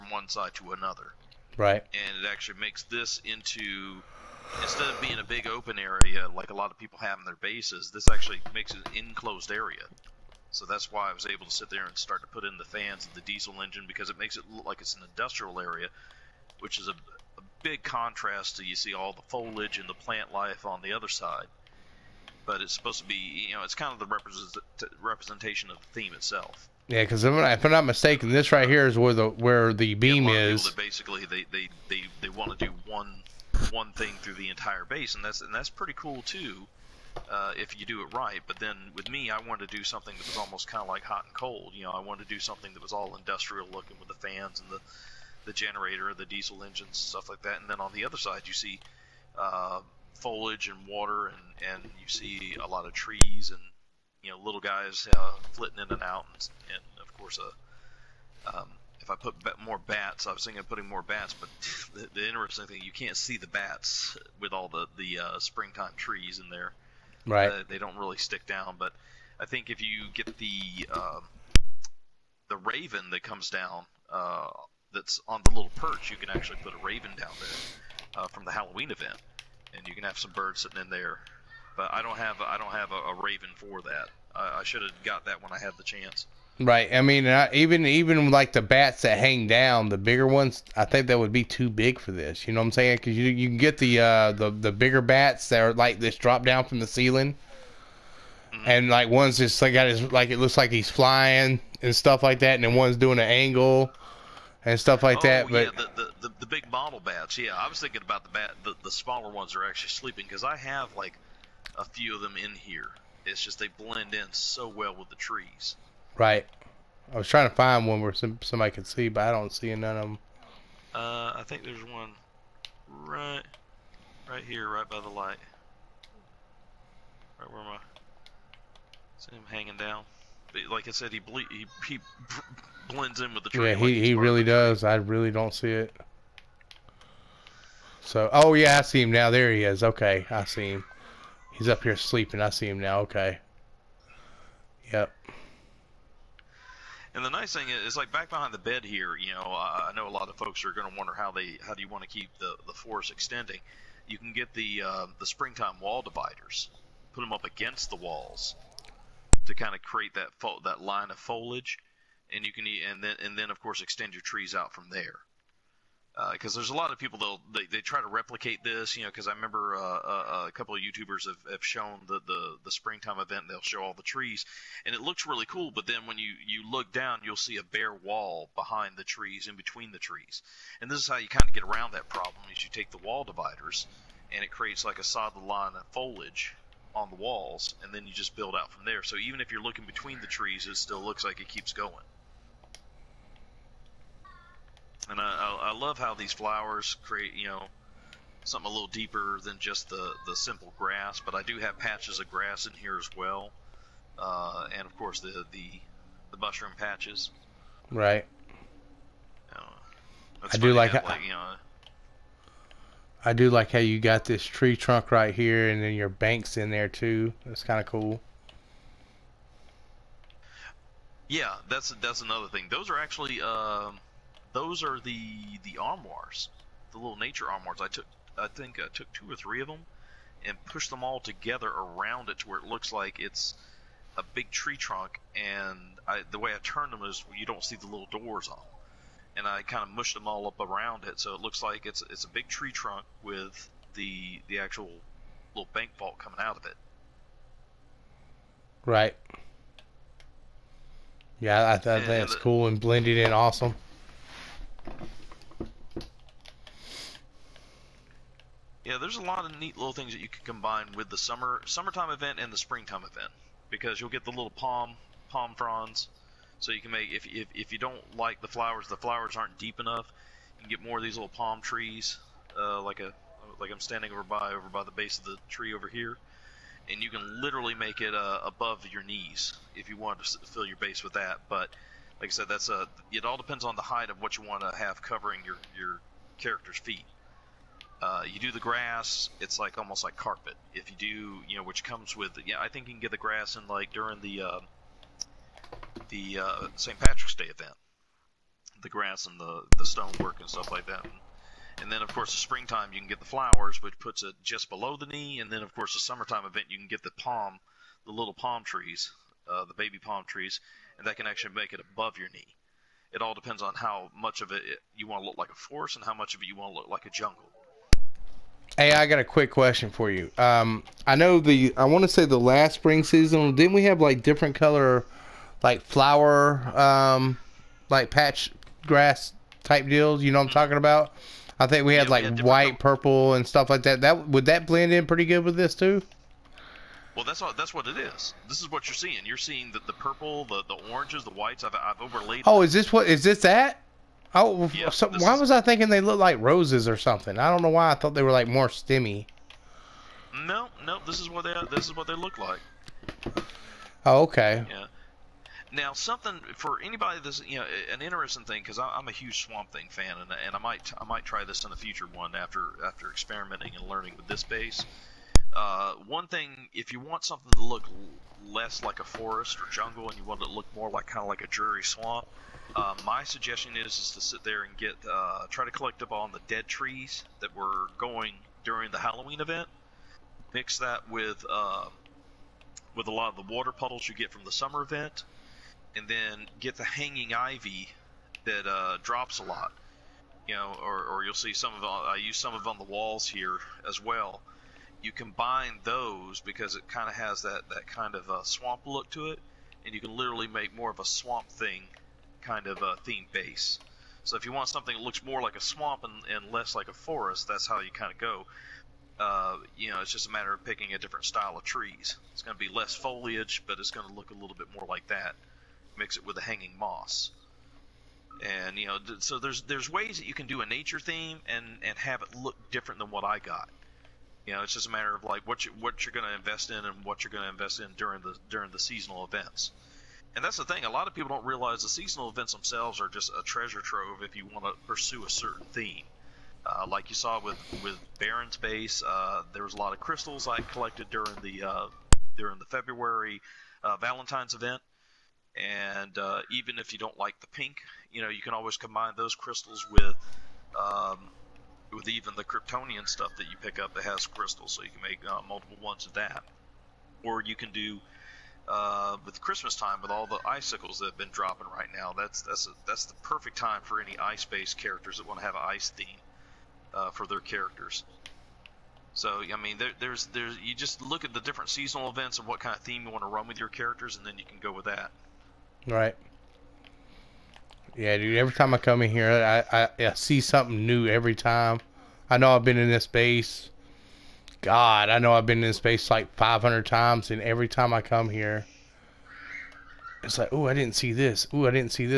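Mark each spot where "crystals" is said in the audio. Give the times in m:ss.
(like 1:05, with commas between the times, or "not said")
7:19, 7:29, 7:34.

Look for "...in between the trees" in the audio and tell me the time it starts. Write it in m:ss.
2:59.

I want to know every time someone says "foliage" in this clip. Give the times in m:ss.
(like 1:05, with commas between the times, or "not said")
0:19, 0:50, 2:41, 3:05, 6:52.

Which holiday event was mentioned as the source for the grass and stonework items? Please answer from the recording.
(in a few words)
St. Patrick's Day.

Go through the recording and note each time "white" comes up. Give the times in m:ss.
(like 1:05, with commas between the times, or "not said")
5:32, 5:41.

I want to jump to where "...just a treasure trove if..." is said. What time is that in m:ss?
7:13.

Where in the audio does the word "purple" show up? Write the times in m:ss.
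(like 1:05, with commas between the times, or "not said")
5:32, 5:39.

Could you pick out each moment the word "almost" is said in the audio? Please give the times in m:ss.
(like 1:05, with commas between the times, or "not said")
0:40, 4:49.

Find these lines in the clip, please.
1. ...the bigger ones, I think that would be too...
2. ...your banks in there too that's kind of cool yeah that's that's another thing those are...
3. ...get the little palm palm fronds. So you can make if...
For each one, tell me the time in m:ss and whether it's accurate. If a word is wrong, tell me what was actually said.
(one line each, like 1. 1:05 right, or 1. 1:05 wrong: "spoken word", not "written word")
1. 1:29 right
2. 3:35 right
3. 4:24 right.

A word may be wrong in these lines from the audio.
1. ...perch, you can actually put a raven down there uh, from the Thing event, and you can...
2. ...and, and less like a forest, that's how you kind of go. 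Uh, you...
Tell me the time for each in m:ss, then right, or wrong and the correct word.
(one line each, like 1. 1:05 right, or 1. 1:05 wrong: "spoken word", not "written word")
1. 1:15 wrong: "Halloween", not "Thing"
2. 6:46 right.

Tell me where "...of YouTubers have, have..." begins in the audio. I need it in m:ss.
2:50.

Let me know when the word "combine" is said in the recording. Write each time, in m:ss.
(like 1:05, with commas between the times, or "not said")
4:20, 6:35, 7:28.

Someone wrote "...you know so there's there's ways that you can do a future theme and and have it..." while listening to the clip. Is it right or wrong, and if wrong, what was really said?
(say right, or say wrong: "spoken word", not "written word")
wrong: "nature", not "future".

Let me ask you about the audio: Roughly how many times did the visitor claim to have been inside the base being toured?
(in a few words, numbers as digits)
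500.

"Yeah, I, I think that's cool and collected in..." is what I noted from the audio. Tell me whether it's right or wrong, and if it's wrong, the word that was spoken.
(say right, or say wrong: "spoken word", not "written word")
wrong: "blended", not "collected".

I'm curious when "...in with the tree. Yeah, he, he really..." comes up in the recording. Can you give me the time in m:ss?
2:13.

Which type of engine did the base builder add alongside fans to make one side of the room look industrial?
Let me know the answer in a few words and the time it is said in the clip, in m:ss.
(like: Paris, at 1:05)
Diesel engine, at 0:13.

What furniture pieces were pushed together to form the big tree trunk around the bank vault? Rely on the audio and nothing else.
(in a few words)
Nature armoires.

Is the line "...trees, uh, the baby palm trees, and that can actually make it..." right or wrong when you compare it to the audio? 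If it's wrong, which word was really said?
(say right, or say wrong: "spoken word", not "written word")
right.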